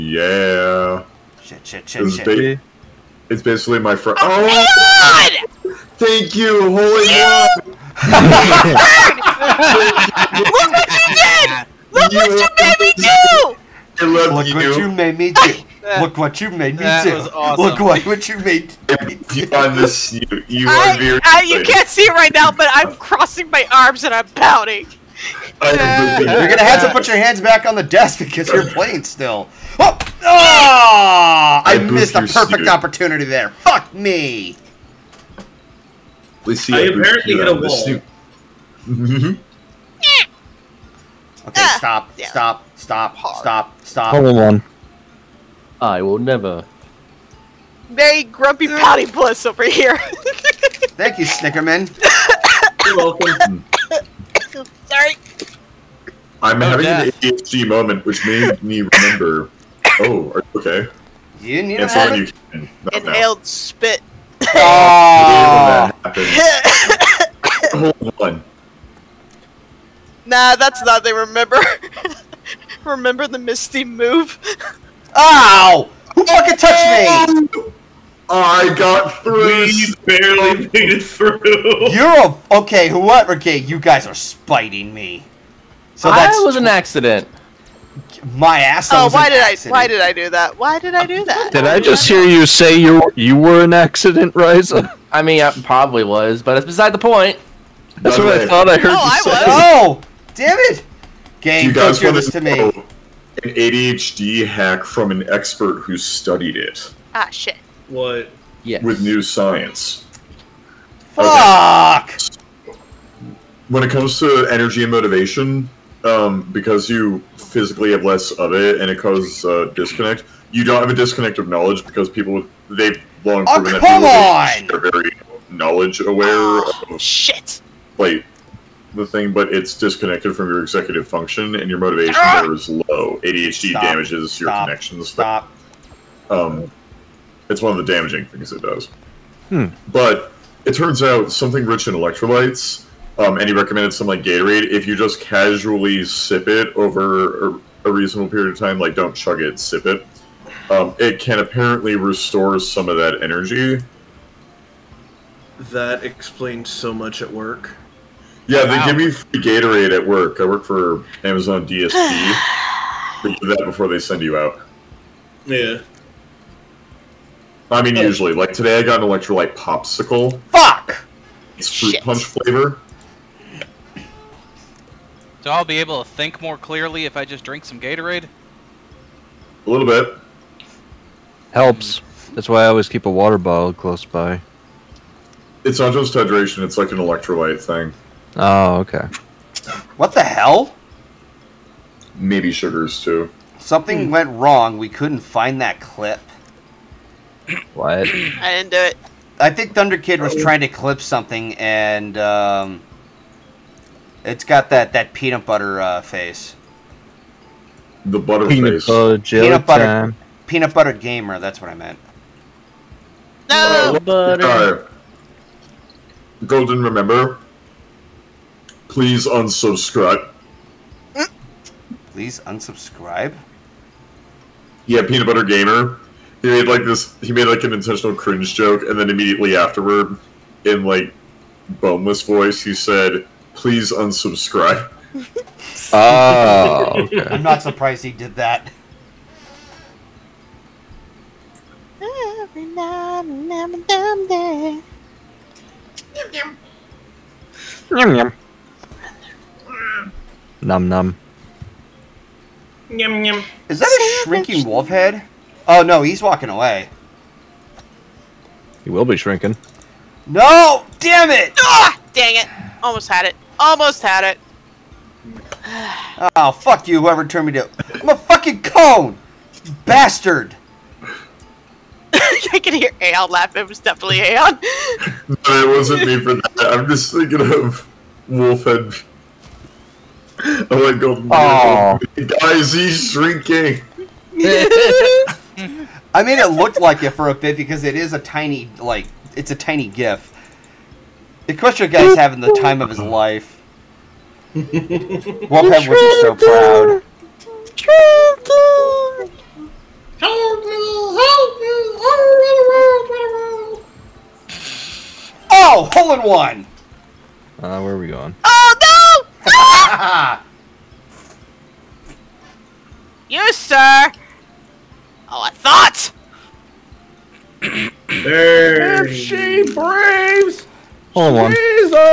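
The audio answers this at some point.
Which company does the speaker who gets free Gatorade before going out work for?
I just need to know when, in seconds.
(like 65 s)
161 s.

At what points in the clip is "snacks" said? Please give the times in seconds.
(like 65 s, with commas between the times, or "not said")
not said.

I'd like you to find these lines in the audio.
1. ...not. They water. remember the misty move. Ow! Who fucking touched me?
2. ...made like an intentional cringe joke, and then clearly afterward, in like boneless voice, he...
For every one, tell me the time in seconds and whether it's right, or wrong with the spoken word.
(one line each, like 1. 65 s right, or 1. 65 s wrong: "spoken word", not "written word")
1. 70 s wrong: "remember", not "water"
2. 227 s wrong: "immediately", not "clearly".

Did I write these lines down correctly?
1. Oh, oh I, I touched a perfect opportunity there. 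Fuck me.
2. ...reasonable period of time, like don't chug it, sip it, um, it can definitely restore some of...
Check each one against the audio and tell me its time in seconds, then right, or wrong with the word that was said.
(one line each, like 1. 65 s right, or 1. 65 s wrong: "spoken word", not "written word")
1. 29 s wrong: "missed", not "touched"
2. 147 s wrong: "apparently", not "definitely".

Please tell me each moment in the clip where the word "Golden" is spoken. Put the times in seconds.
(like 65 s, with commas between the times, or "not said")
216 s.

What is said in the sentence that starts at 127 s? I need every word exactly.
Like, the thing, but it's disconnected from your executive function, and your motivation ah!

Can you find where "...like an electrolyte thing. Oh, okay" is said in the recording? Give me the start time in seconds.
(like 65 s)
186 s.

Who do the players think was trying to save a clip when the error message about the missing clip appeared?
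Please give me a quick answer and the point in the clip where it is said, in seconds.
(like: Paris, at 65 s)
Thunder Kid, at 199 s.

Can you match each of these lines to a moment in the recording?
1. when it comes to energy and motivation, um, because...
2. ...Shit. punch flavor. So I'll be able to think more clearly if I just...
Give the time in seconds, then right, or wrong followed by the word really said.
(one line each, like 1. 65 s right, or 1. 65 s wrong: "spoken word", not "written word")
1. 113 s right
2. 171 s right.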